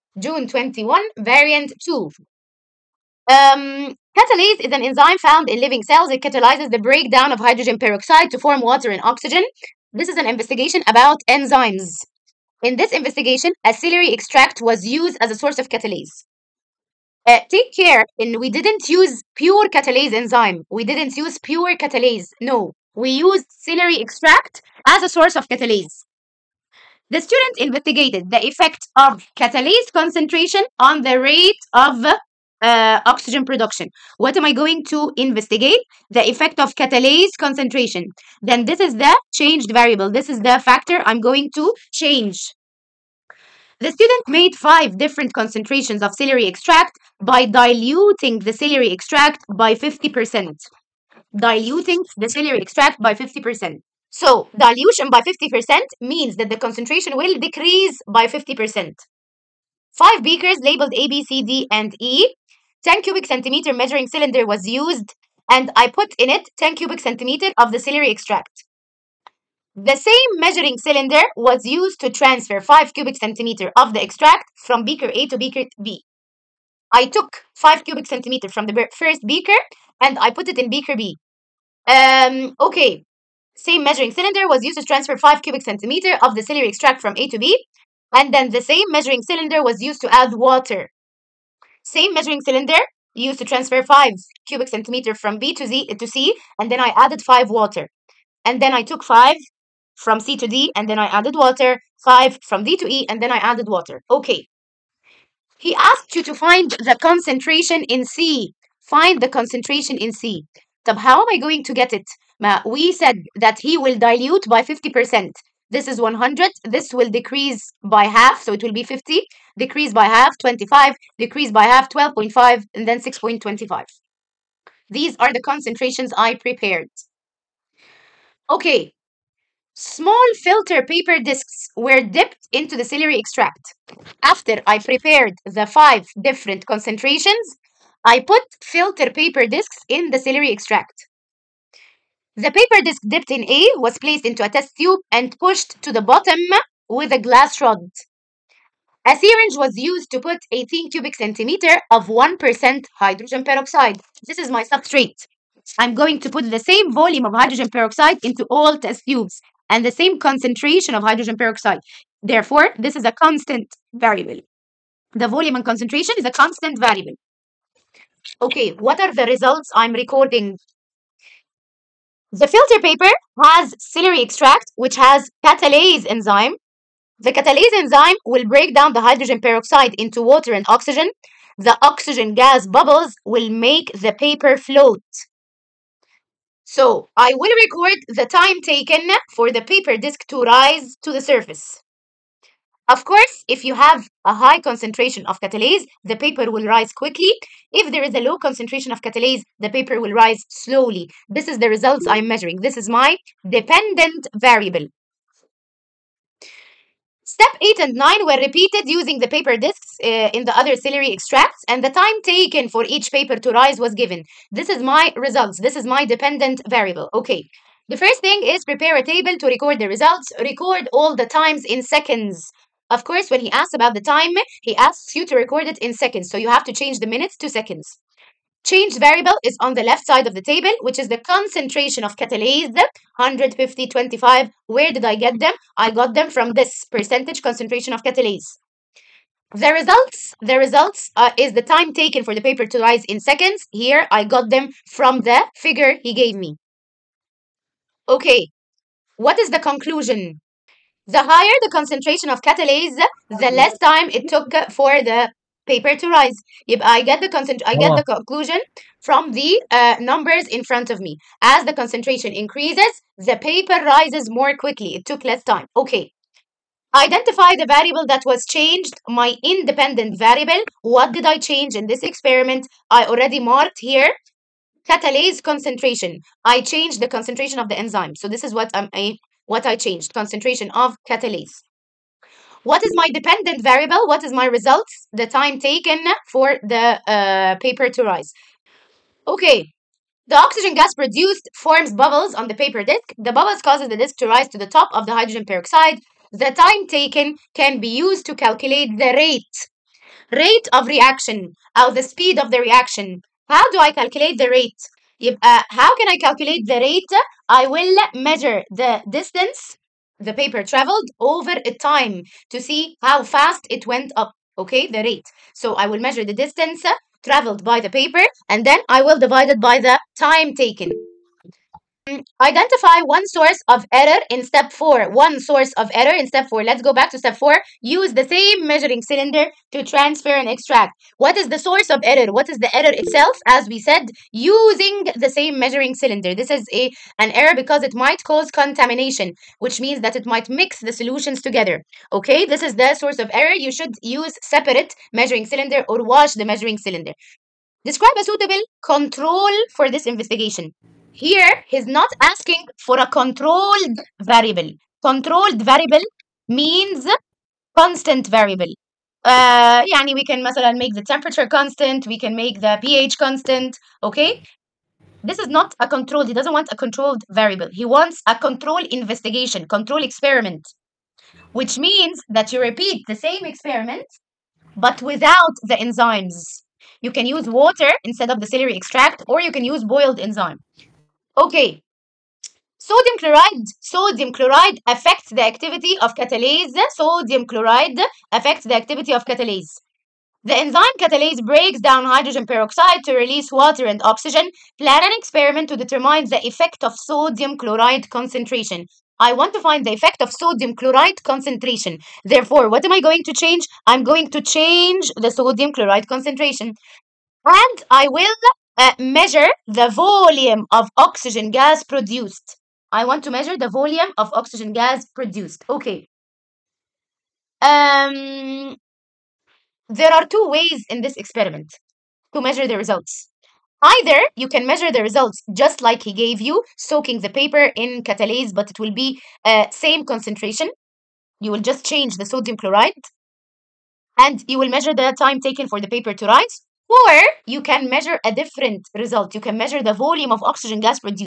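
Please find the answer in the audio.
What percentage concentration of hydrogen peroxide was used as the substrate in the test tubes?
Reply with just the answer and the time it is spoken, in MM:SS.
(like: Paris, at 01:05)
1%, at 02:32.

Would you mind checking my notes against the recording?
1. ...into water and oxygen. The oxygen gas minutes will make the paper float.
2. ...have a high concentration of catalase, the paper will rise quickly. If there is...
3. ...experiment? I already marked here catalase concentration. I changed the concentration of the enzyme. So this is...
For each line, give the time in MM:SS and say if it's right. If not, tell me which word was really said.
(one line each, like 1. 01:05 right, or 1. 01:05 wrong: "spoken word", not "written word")
1. 02:59 wrong: "bubbles", not "minutes"
2. 03:13 right
3. 04:32 right.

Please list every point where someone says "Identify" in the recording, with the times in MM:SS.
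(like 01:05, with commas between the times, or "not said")
04:26, 05:22.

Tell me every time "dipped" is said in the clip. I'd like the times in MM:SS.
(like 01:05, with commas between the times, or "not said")
02:12, 02:23.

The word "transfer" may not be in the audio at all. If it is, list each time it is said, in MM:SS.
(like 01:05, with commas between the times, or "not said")
01:12, 01:24, 01:33, 05:29.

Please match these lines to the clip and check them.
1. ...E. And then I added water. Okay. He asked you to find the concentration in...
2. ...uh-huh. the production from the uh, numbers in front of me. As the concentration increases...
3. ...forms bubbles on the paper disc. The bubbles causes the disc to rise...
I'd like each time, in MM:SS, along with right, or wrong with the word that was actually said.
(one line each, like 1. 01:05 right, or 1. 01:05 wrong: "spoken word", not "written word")
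1. 01:42 right
2. 04:17 wrong: "conclusion", not "production"
3. 04:51 right.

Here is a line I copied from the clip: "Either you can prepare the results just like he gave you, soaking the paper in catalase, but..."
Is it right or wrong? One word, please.
wrong.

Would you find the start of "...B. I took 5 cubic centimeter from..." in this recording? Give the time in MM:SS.
01:15.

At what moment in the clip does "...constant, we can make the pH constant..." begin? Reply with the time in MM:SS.
06:01.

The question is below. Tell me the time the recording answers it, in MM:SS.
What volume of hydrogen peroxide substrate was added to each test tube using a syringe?
02:30.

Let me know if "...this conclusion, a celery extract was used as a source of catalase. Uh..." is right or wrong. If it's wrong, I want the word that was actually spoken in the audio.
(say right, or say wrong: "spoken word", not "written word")
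wrong: "investigation", not "conclusion".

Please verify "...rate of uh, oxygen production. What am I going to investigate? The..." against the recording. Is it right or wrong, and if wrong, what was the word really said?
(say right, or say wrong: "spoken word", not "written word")
right.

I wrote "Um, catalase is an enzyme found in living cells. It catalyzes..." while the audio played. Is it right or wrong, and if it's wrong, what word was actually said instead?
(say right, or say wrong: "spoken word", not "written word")
right.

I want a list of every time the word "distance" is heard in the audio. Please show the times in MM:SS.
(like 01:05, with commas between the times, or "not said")
05:09, 05:16.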